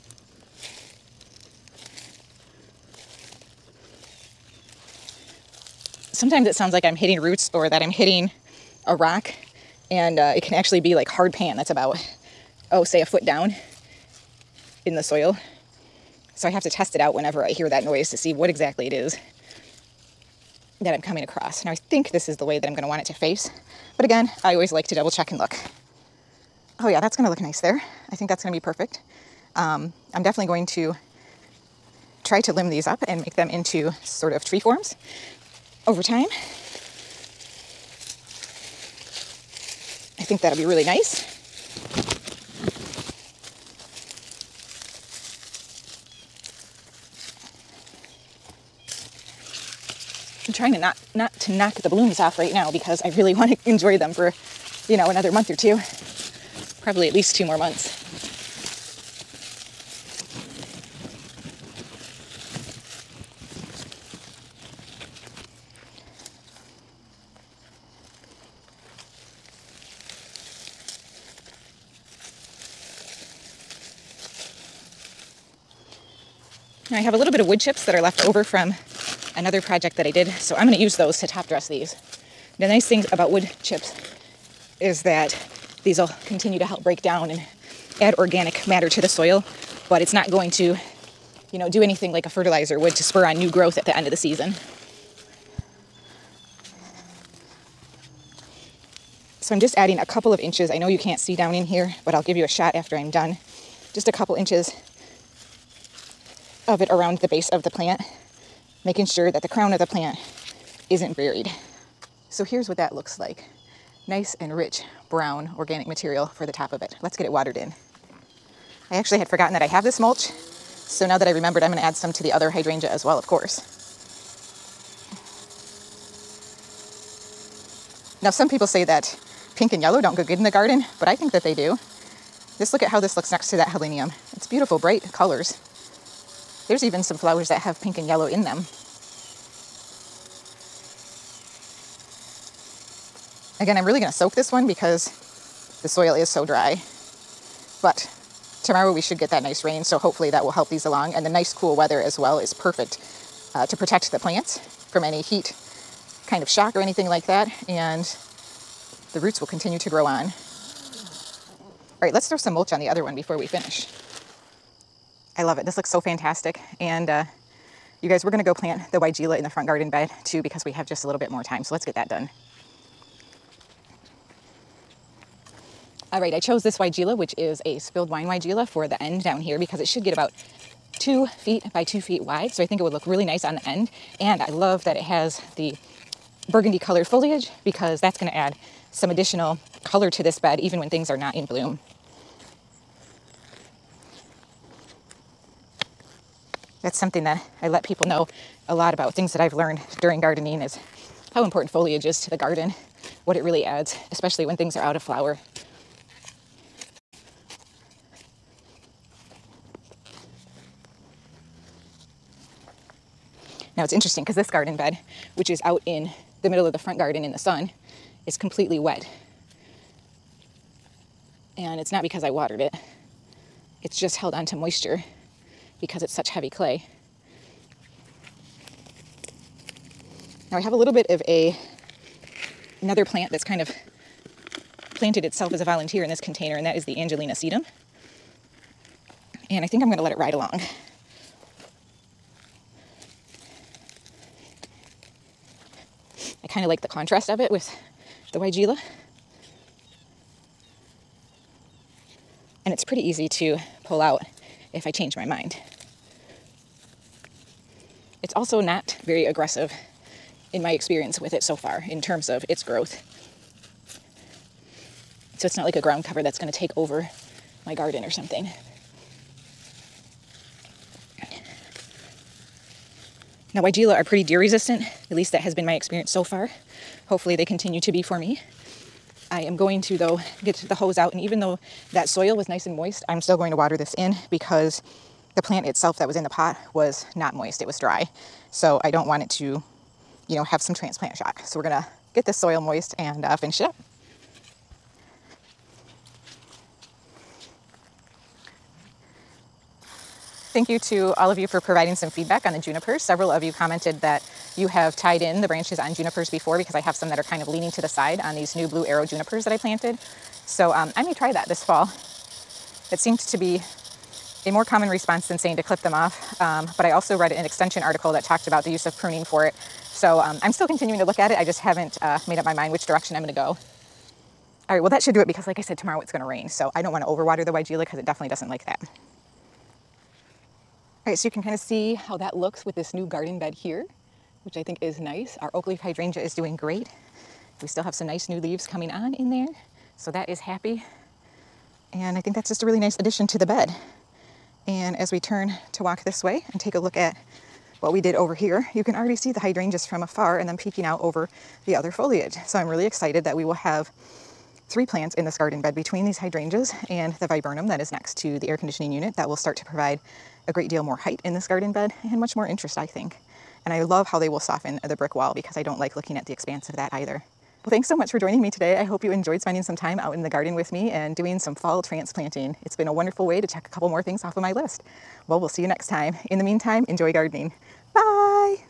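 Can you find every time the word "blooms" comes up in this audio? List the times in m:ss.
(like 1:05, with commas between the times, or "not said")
0:51, 3:11.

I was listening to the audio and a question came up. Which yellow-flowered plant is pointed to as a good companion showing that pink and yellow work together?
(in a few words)
helenium.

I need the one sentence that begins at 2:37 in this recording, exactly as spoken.
And the roots will continue to grow on.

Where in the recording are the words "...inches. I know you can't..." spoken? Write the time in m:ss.
1:40.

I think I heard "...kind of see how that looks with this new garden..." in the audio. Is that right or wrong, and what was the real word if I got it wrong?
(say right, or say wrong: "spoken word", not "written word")
right.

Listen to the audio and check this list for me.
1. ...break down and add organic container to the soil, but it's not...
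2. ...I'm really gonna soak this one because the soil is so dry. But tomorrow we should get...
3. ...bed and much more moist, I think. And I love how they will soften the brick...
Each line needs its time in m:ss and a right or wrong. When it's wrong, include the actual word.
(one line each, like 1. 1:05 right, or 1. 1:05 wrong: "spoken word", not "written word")
1. 1:26 wrong: "matter", not "container"
2. 2:23 right
3. 6:01 wrong: "interest", not "moist".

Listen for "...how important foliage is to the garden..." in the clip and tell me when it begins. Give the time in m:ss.
3:21.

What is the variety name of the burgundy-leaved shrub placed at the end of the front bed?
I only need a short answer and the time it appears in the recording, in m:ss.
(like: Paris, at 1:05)
spilled wine, at 2:57.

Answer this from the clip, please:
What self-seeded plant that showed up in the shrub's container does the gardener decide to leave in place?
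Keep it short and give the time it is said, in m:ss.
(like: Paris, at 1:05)
Angelina sedum, at 3:57.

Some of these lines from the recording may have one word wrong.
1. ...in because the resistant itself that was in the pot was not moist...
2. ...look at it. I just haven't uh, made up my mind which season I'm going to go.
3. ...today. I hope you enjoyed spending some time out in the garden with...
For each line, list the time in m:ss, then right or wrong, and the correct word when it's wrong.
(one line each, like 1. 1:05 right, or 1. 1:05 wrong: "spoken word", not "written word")
1. 4:43 wrong: "plant", not "resistant"
2. 5:21 wrong: "direction", not "season"
3. 6:08 right.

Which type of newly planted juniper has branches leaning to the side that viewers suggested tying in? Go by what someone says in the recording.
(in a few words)
blue arrow.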